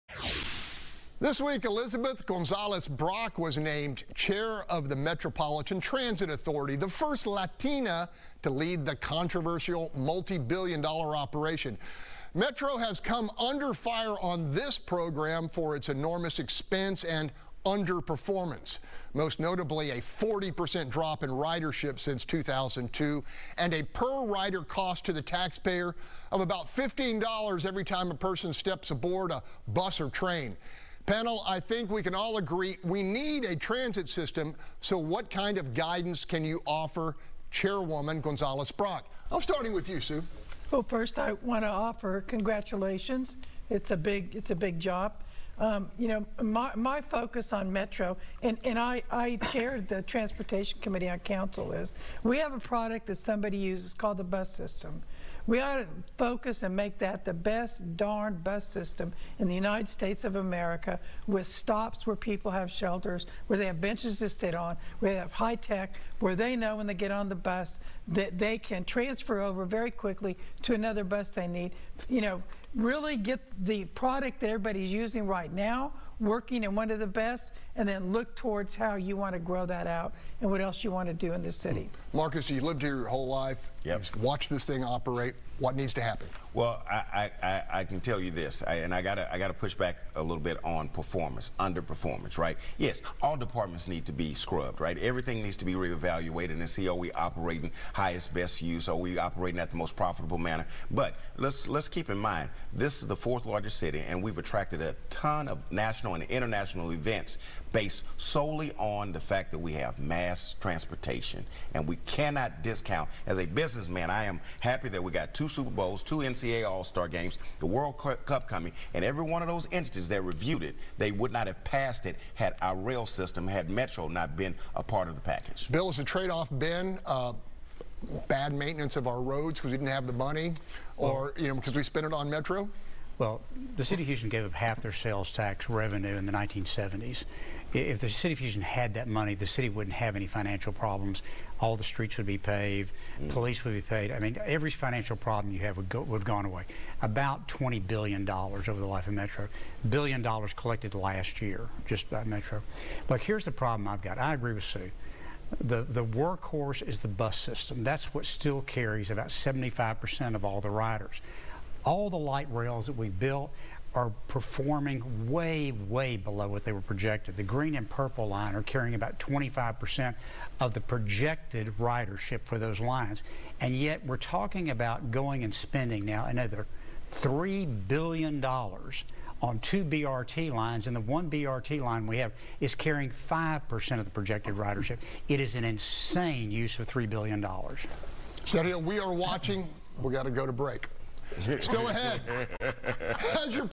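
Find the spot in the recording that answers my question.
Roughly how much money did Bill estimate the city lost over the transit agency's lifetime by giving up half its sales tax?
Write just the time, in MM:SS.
02:27.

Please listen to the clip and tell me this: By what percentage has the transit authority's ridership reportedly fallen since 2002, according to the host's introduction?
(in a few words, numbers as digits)
40%.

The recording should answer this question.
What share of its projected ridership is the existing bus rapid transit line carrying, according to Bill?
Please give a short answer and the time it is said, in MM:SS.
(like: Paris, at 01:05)
5%, at 03:03.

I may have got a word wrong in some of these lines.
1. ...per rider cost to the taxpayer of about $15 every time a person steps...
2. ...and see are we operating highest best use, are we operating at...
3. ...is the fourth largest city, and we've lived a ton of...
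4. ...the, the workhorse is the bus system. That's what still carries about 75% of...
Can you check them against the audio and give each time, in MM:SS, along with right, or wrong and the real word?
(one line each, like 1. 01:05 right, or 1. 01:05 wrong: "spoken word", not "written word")
1. 00:23 right
2. 01:36 right
3. 01:43 wrong: "attracted", not "lived"
4. 02:35 right.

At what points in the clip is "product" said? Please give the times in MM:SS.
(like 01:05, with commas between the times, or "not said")
00:52, 01:13.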